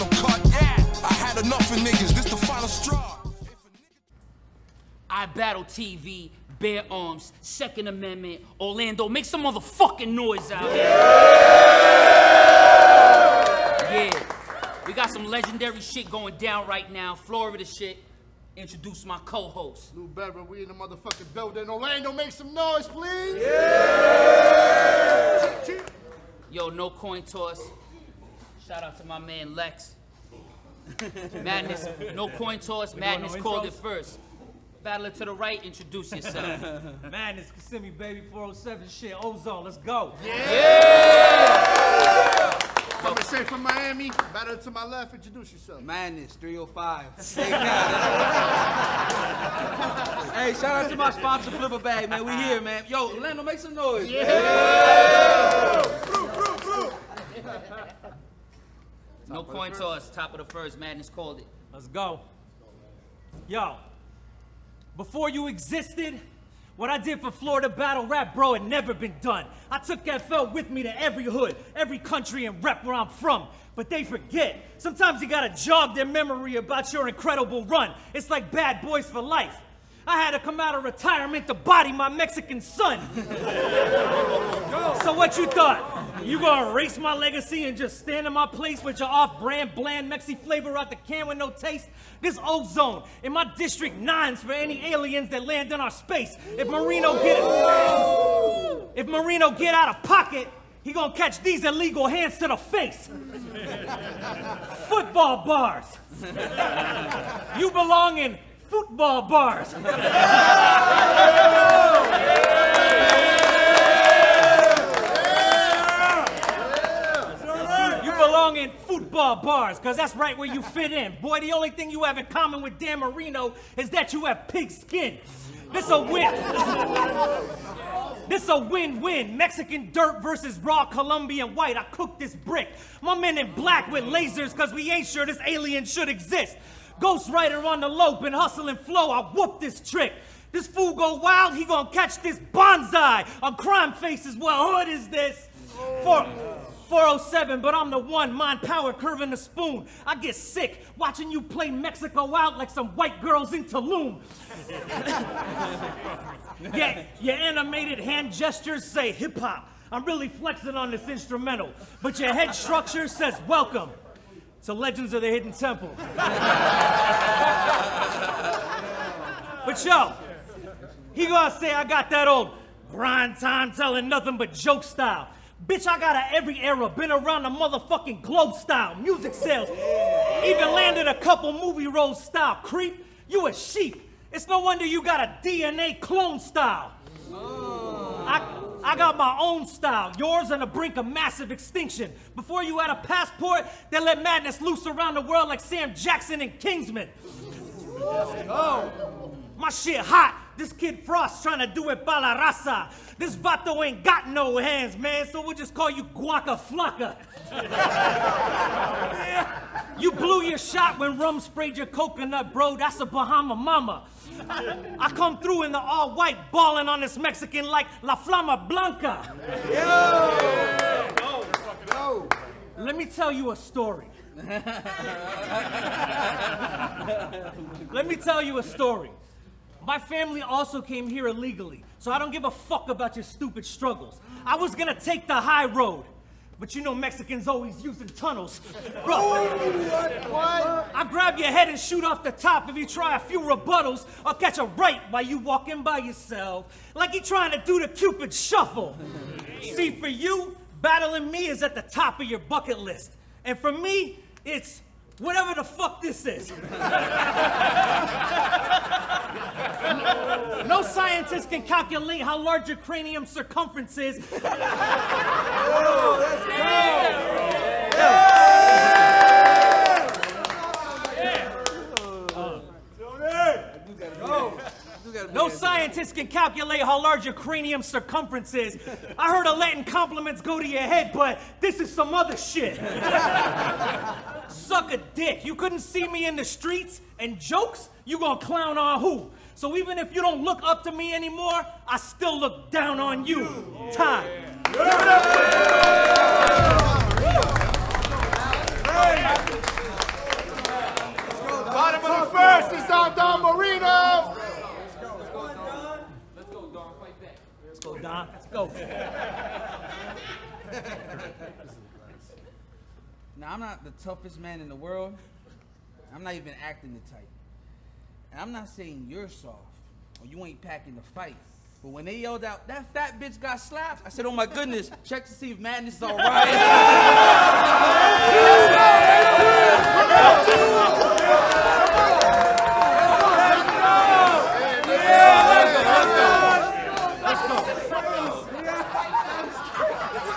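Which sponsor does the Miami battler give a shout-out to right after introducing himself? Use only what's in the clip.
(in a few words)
Flip a Bag.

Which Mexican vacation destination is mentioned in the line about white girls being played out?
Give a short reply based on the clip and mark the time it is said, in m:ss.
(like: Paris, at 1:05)
Tulum, at 2:33.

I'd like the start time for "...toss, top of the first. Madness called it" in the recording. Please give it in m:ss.
0:59.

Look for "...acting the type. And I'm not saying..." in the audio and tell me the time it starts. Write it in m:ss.
5:16.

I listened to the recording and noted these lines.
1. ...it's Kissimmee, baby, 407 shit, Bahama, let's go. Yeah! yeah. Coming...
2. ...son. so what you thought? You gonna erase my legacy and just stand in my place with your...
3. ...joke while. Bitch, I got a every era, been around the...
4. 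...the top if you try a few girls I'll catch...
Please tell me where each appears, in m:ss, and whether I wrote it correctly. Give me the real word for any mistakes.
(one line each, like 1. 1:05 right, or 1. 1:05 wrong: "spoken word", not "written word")
1. 0:37 wrong: "Ozone", not "Bahama"
2. 1:22 right
3. 2:54 wrong: "style", not "while"
4. 4:02 wrong: "rebuttals", not "girls".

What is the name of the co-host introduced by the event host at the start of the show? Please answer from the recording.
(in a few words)
Lou Bedford.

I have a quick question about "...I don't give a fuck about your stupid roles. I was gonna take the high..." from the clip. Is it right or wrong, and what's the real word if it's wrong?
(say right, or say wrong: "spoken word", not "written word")
wrong: "struggles", not "roles".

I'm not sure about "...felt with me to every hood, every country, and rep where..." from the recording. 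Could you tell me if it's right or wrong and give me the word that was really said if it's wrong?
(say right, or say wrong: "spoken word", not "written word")
right.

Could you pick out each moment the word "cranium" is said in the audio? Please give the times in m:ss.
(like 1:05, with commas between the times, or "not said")
4:22, 4:37.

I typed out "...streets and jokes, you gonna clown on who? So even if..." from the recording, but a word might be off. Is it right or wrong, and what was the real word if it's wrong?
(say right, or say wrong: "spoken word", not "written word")
right.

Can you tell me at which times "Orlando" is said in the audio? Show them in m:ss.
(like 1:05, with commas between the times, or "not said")
0:08, 0:21, 0:53.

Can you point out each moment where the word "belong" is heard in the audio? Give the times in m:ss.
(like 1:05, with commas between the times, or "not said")
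1:47, 1:58.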